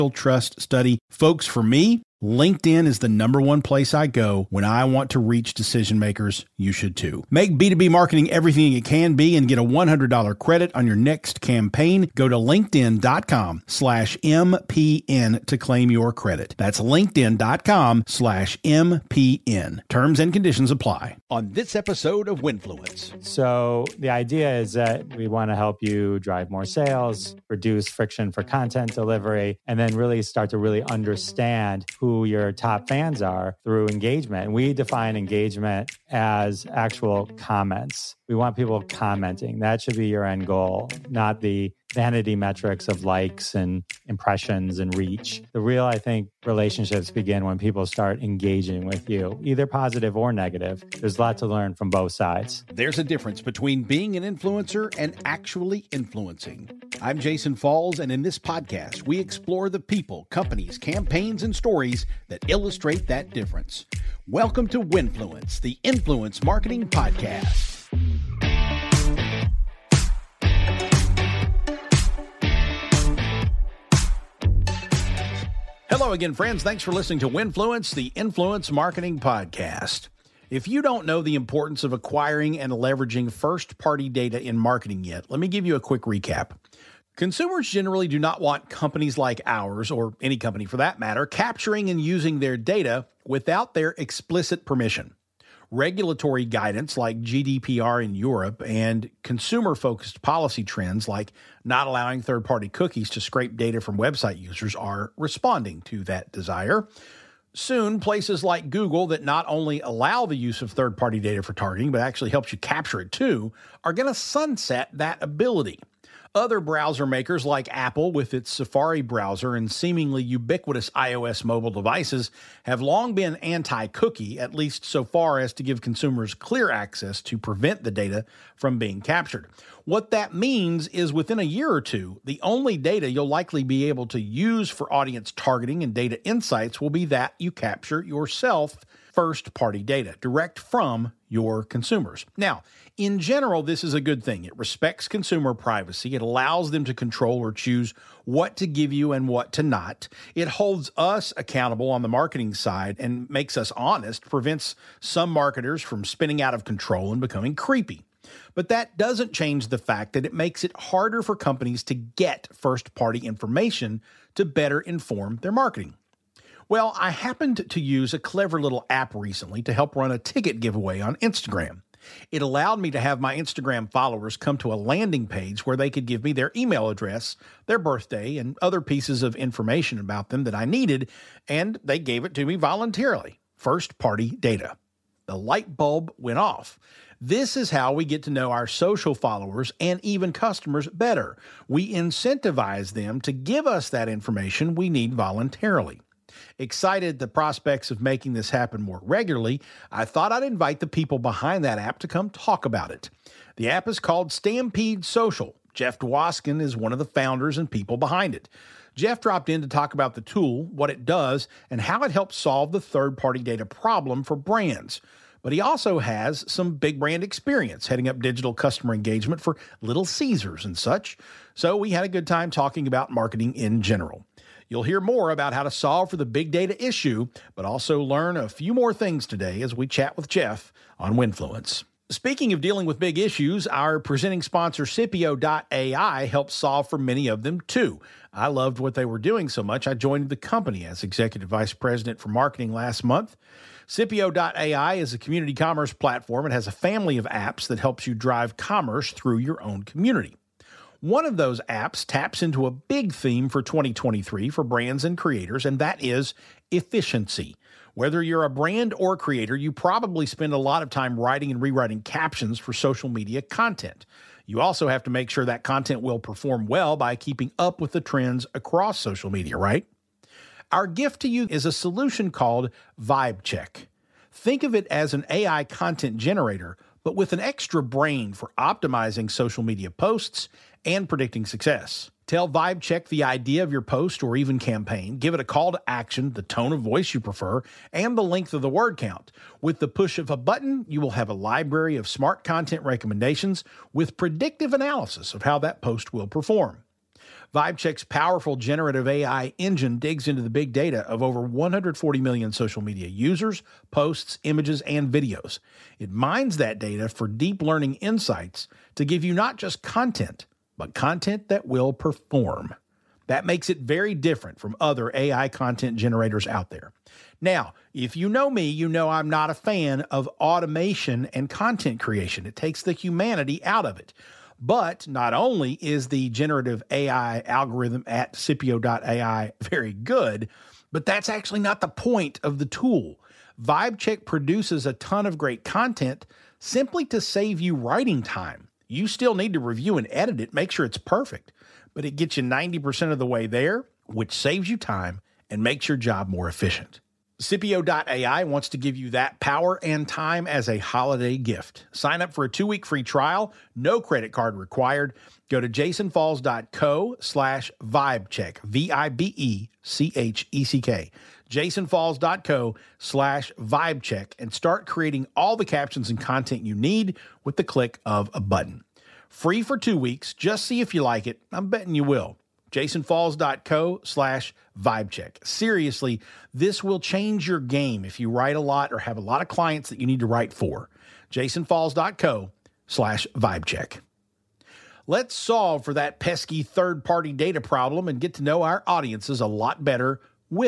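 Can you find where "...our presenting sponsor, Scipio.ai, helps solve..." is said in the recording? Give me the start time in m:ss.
3:53.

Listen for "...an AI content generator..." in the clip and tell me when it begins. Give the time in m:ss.
4:35.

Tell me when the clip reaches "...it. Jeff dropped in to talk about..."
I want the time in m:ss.
3:28.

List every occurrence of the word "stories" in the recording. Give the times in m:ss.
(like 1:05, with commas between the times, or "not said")
1:01.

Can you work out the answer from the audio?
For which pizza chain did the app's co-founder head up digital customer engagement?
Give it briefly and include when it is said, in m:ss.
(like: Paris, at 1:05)
Little Caesars, at 3:39.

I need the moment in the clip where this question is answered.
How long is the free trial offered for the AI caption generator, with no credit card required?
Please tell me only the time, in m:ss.
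5:52.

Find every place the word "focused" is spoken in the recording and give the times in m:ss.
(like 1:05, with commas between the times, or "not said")
1:39.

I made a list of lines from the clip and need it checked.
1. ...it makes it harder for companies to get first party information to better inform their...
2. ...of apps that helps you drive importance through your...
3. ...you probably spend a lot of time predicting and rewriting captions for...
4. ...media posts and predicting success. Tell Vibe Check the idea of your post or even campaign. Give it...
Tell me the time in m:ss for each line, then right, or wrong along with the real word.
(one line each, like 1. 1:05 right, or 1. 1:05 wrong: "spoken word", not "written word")
1. 2:40 right
2. 4:07 wrong: "commerce", not "importance"
3. 4:19 wrong: "writing", not "predicting"
4. 4:39 right.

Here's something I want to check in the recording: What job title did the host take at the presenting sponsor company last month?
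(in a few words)
executive vice president for marketing.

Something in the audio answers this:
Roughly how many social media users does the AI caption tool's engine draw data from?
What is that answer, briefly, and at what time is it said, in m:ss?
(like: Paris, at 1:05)
140 million, at 5:01.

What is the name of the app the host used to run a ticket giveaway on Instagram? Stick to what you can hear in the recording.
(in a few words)
Stampede Social.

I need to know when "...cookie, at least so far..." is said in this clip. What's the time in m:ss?
2:03.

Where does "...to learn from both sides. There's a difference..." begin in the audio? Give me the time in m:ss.
0:51.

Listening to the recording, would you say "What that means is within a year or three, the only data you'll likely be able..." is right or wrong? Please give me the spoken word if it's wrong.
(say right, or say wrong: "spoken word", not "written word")
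wrong: "two", not "three".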